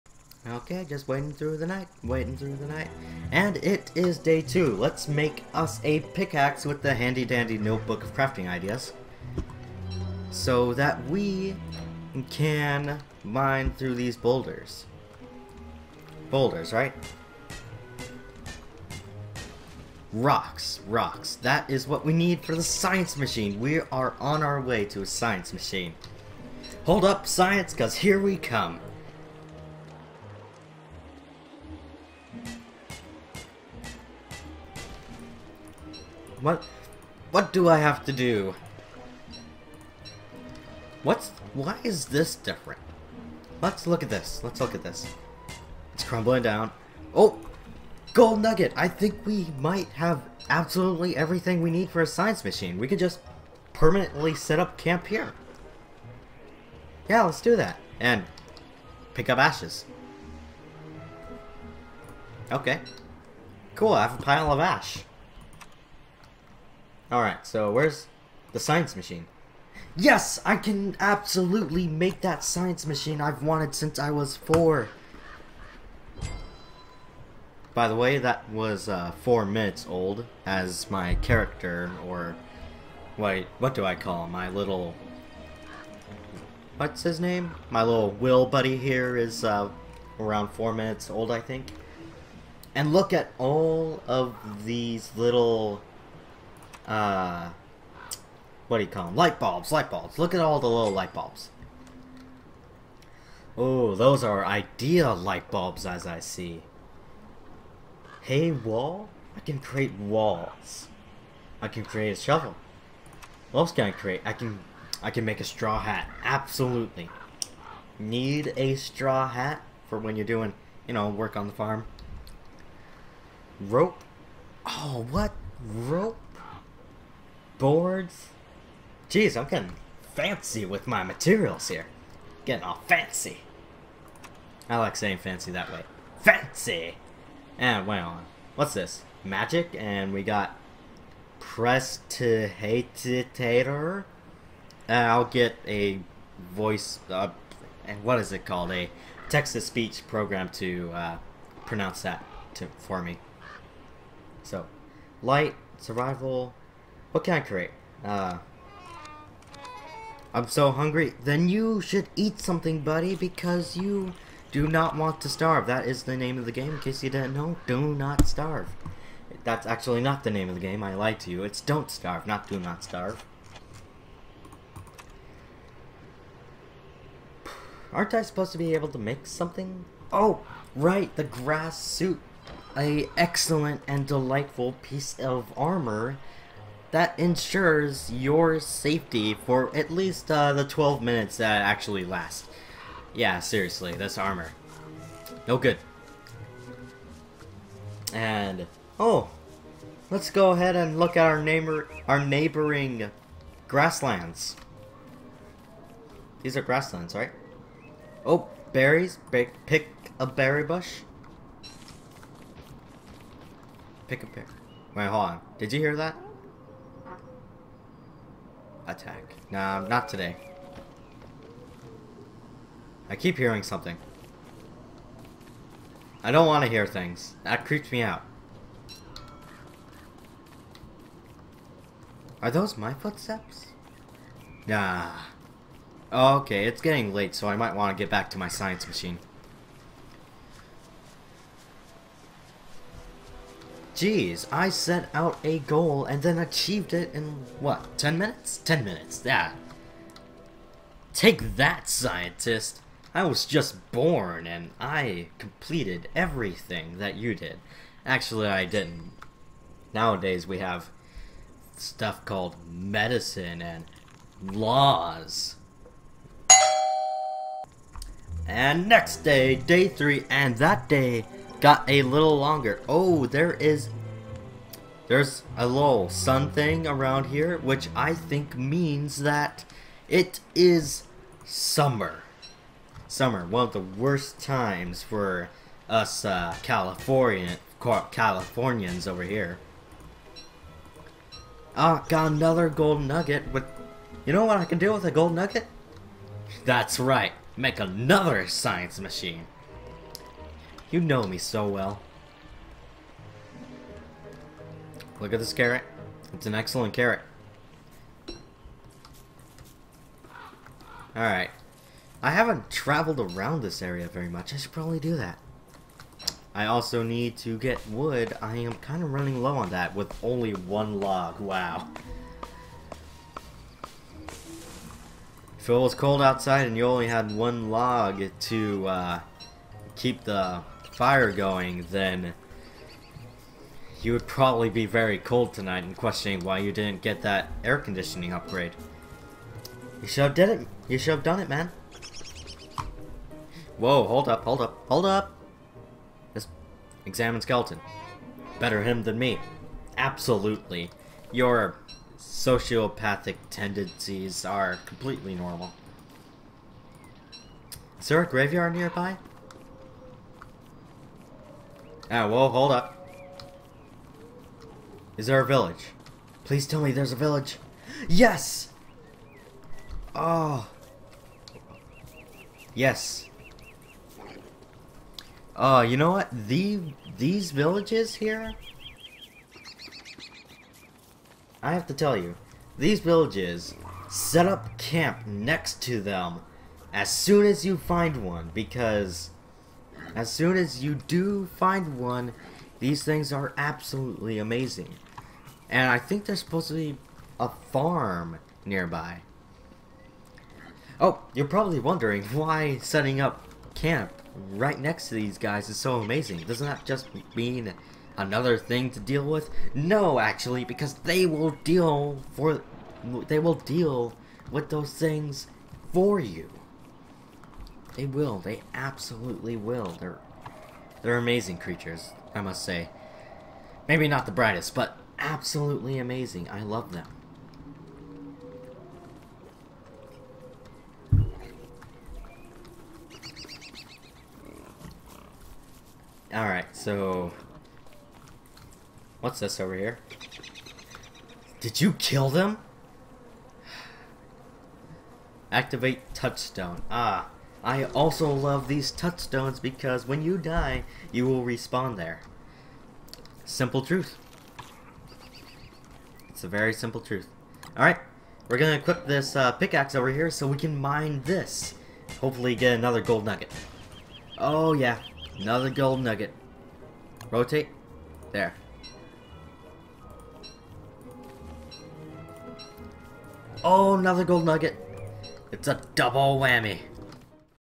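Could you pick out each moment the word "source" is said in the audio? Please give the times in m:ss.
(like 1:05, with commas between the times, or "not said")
not said.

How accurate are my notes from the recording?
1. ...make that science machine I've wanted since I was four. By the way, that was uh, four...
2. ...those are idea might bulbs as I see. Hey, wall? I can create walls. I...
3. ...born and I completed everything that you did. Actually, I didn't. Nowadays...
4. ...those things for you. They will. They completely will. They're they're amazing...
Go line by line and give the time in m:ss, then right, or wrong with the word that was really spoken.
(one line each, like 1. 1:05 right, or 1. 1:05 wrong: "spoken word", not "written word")
1. 1:11 right
2. 1:43 wrong: "light", not "might"
3. 4:13 right
4. 6:54 wrong: "absolutely", not "completely".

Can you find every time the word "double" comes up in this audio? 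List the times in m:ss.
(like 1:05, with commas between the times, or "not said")
7:55.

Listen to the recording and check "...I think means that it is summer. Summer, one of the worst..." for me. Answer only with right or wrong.
right.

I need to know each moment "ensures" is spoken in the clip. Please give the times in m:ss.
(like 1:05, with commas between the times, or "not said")
3:07.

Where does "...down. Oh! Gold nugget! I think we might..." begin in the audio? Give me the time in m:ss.
0:46.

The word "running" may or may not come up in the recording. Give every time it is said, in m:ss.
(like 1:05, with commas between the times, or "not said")
5:19.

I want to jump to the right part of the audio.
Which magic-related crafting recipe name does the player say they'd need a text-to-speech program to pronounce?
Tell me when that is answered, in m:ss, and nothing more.
2:21.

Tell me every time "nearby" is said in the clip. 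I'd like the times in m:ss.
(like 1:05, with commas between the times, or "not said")
5:58, 6:38.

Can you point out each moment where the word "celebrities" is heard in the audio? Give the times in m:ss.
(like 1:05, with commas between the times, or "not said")
not said.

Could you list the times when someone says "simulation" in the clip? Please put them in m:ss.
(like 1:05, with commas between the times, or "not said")
not said.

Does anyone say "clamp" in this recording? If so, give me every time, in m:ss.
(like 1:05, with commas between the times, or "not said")
not said.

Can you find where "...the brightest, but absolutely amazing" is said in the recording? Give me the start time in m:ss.
7:04.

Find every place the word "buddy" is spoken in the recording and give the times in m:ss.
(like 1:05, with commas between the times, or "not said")
1:28, 2:42.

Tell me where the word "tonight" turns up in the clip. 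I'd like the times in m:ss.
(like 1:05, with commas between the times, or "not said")
5:35.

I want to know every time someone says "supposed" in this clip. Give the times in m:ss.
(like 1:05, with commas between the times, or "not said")
2:58, 6:36.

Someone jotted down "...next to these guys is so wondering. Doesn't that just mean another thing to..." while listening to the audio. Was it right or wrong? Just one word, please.
wrong.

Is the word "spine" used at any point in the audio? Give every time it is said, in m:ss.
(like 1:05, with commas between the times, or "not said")
not said.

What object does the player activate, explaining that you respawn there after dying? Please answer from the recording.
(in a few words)
touchstone.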